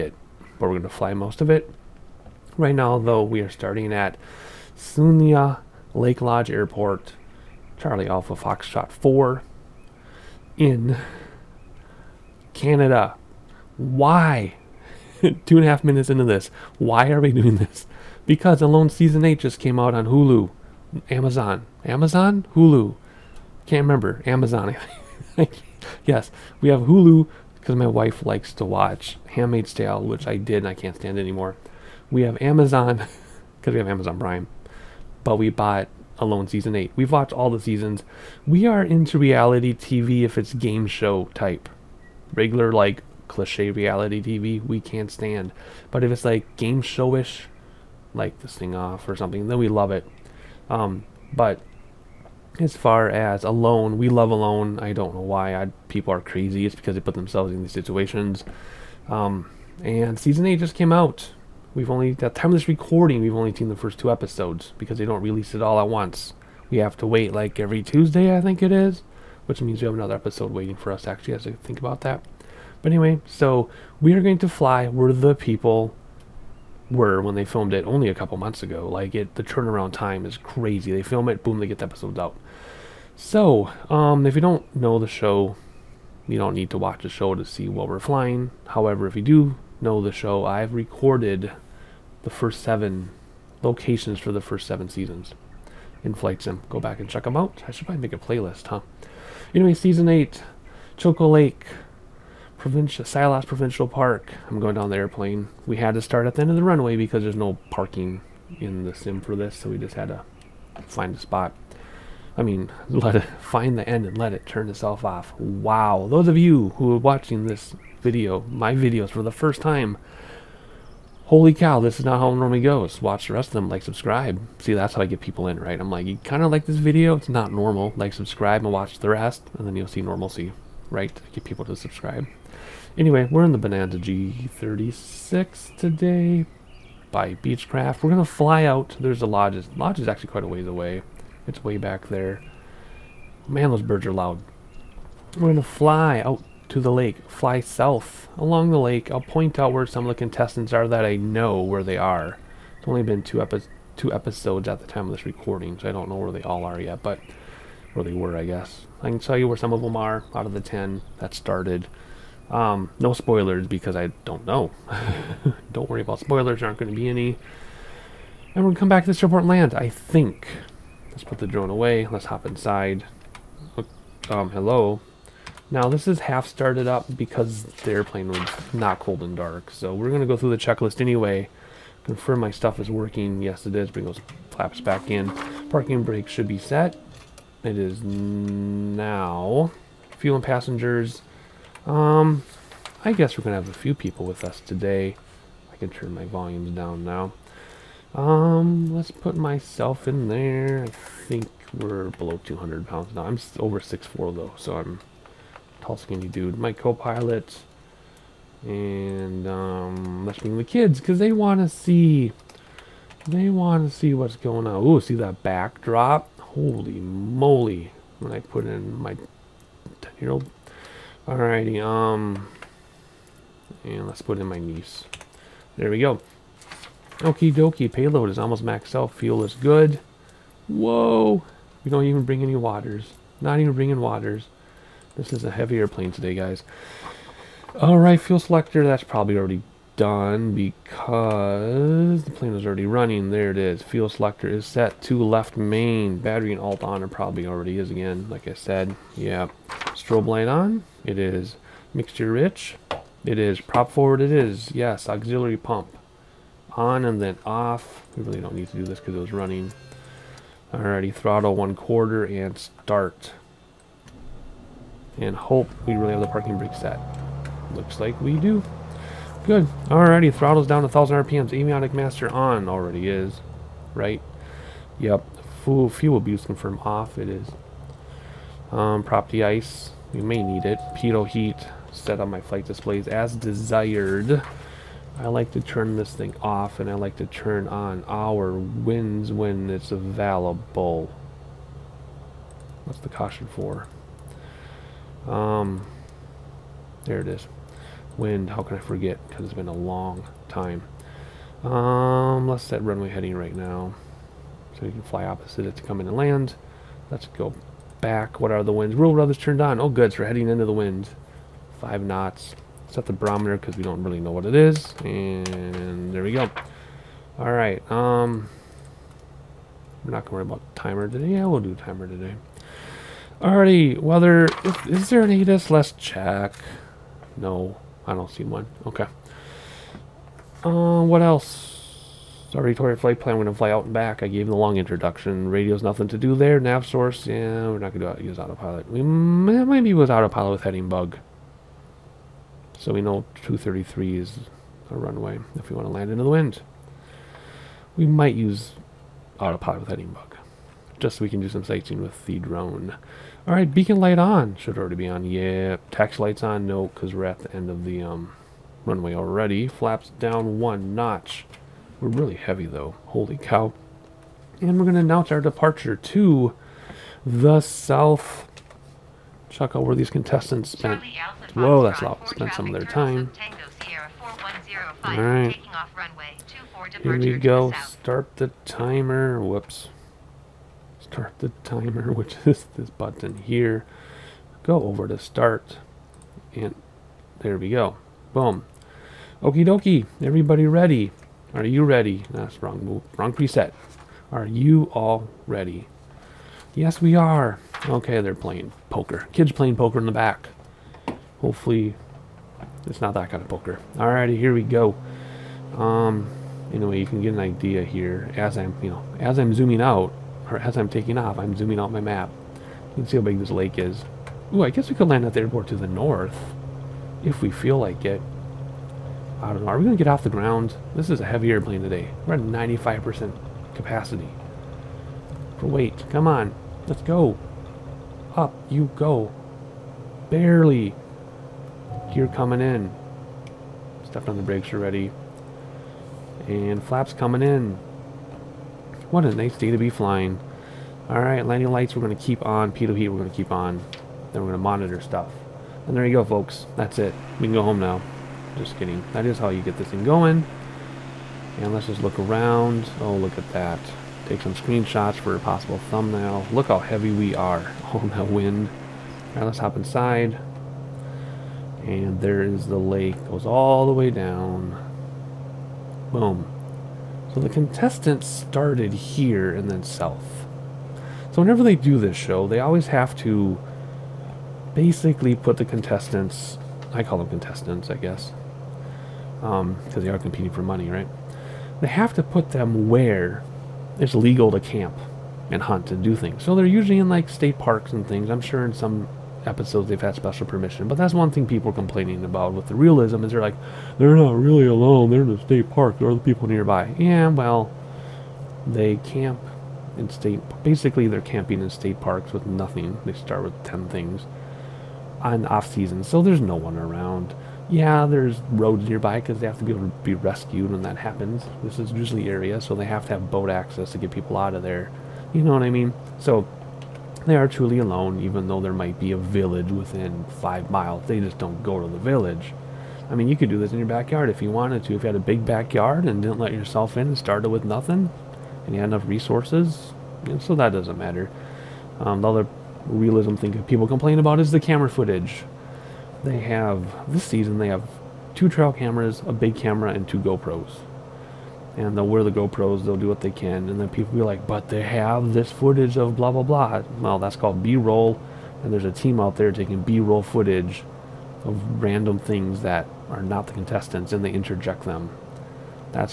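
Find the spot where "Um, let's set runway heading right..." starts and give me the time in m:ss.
5:01.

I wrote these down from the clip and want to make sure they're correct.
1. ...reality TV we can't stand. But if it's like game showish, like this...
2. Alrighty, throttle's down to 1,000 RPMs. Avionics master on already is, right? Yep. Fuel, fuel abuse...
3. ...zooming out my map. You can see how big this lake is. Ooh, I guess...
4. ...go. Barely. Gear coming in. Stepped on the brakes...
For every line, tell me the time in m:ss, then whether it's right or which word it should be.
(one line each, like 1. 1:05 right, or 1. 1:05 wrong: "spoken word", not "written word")
1. 0:43 right
2. 4:29 right
3. 6:51 right
4. 7:08 right.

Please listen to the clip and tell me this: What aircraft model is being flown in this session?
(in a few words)
Bonanza G36.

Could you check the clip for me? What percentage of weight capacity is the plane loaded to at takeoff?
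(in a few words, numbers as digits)
95%.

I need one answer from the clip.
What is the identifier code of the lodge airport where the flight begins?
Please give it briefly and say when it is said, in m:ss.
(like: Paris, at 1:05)
CAF4, at 0:07.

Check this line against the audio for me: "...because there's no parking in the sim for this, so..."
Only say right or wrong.
right.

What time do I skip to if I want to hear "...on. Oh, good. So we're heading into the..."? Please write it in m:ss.
5:09.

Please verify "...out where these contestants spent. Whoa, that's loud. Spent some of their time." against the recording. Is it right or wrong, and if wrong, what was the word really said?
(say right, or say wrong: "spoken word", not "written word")
right.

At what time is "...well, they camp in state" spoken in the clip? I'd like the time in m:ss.
8:17.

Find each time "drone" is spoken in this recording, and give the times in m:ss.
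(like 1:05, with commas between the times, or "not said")
2:51, 5:52.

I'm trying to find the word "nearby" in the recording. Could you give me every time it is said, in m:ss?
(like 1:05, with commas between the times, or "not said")
8:16, 8:28.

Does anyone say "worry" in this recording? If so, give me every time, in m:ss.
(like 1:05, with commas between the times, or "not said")
2:45, 5:20.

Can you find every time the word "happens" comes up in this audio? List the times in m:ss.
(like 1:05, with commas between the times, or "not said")
8:30.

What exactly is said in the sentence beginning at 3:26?
My co-pilot and um, let's bring the kids because they want to see they want to see what's going on.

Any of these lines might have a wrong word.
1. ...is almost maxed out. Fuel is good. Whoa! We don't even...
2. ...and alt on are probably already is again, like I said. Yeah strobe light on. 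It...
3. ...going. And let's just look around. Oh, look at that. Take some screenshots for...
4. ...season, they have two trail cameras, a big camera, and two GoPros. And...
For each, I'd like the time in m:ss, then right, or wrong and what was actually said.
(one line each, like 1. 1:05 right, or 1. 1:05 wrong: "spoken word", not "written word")
1. 3:48 right
2. 4:06 right
3. 7:30 right
4. 8:57 right.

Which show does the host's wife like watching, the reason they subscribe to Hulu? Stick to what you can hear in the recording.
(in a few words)
Handmaid's Tale.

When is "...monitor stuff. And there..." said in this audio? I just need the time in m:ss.
7:24.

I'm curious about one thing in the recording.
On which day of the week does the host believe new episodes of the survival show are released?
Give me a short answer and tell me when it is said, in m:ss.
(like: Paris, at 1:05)
Tuesday, at 1:07.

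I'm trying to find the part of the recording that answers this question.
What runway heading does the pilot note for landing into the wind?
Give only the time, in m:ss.
5:43.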